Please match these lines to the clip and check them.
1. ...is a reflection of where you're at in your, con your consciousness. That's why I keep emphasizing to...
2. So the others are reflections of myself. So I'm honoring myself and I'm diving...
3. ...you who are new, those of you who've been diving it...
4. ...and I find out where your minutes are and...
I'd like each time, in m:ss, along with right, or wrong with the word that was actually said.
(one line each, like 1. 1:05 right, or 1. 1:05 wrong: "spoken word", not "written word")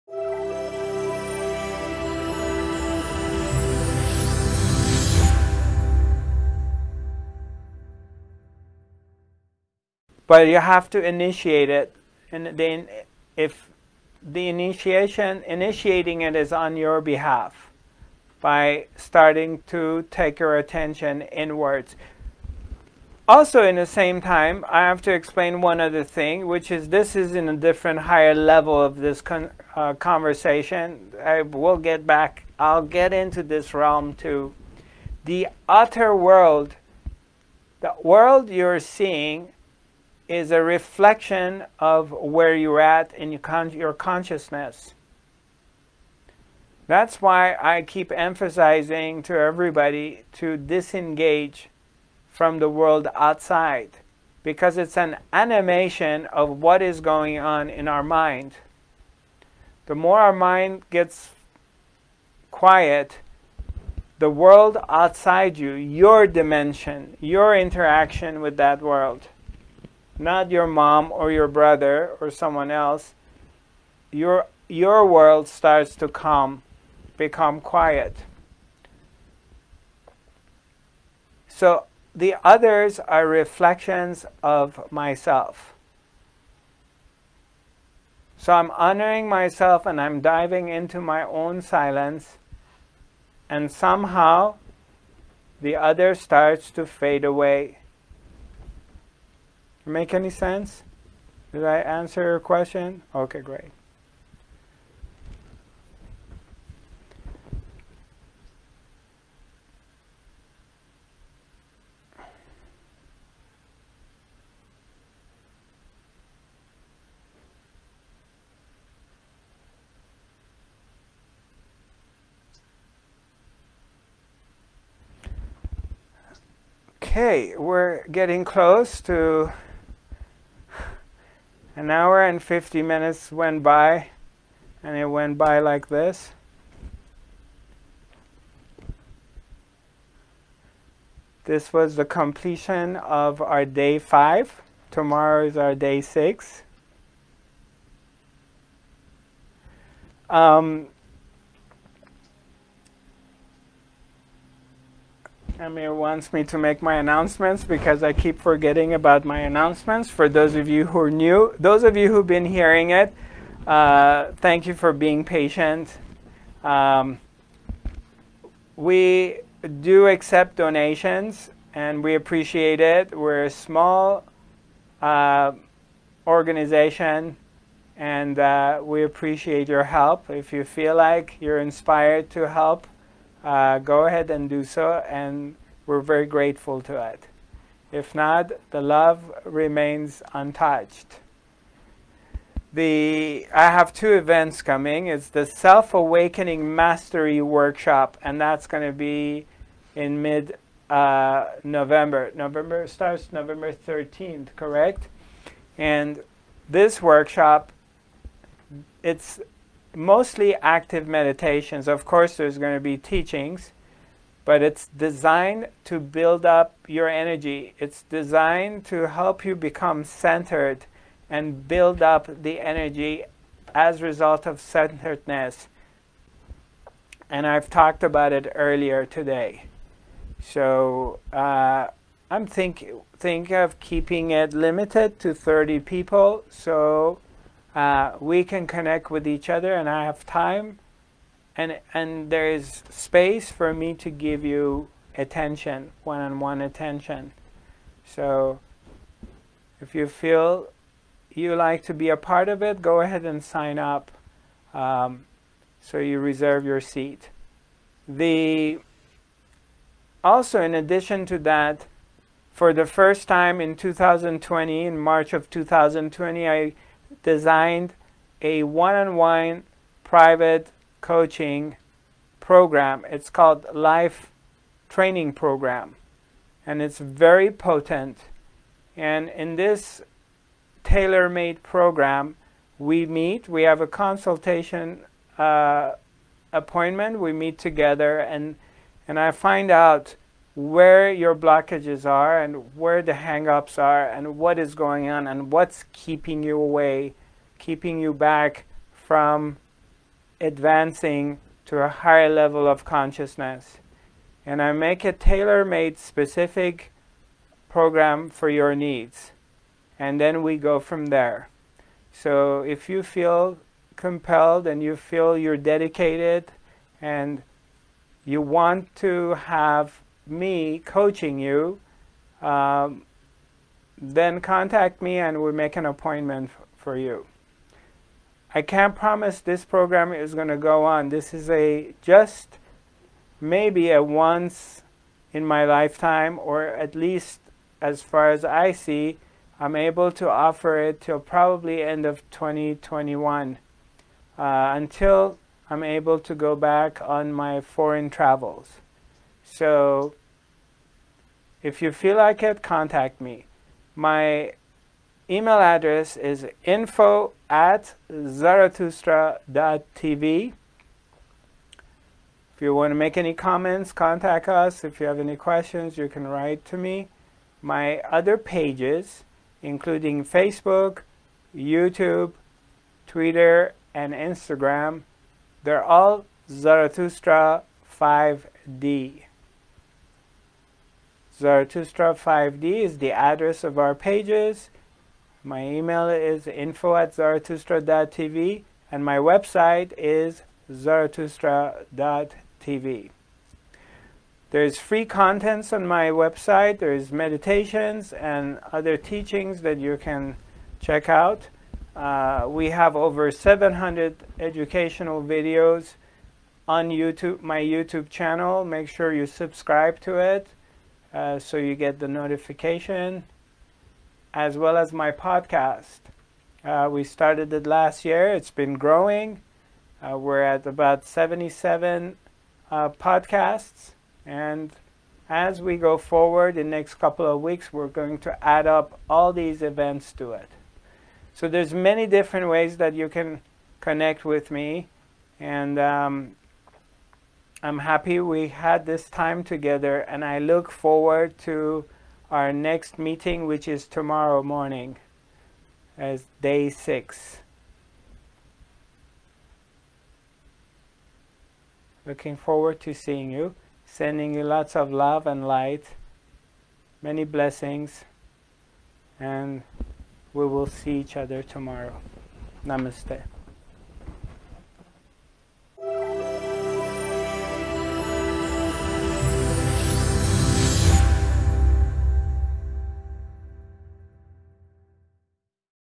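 1. 0:40 right
2. 1:21 right
3. 2:40 wrong: "hearing", not "diving"
4. 4:49 wrong: "blockages", not "minutes".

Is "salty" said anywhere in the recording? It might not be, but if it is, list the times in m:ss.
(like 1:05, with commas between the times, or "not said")
not said.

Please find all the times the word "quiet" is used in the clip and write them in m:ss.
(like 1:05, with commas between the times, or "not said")
1:02, 1:17.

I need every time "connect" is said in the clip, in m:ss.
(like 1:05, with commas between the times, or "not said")
3:58, 7:13.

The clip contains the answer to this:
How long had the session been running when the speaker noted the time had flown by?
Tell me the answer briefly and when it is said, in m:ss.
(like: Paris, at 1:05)
an hour and 50 minutes, at 2:11.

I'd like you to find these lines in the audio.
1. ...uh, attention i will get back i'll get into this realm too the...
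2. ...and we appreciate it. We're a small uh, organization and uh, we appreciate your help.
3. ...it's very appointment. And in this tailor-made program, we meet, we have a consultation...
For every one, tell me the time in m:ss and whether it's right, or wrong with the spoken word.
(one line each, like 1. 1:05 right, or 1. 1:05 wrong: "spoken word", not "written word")
1. 0:29 wrong: "conversation", not "attention"
2. 2:51 right
3. 4:36 wrong: "potent", not "appointment".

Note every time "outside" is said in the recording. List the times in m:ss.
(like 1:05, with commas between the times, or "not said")
0:53, 1:04.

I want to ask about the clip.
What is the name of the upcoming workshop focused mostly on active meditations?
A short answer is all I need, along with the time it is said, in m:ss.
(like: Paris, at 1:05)
Self Awakening Mastery Workshop, at 3:15.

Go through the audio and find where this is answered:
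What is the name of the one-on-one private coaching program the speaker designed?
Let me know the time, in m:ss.
4:33.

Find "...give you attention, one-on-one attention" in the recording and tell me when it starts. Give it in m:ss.
4:04.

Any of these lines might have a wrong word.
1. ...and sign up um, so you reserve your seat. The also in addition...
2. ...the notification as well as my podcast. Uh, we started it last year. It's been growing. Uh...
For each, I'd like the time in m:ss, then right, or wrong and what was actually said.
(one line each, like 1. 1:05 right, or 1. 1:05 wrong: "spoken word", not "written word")
1. 4:13 right
2. 6:51 right.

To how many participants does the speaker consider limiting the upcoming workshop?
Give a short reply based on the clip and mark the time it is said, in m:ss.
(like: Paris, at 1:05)
30, at 3:55.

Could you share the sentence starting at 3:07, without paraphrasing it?
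If not, the love remains untouched.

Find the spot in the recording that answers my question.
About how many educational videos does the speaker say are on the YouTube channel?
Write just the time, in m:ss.
6:42.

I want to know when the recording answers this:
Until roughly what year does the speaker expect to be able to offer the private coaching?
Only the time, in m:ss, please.
5:41.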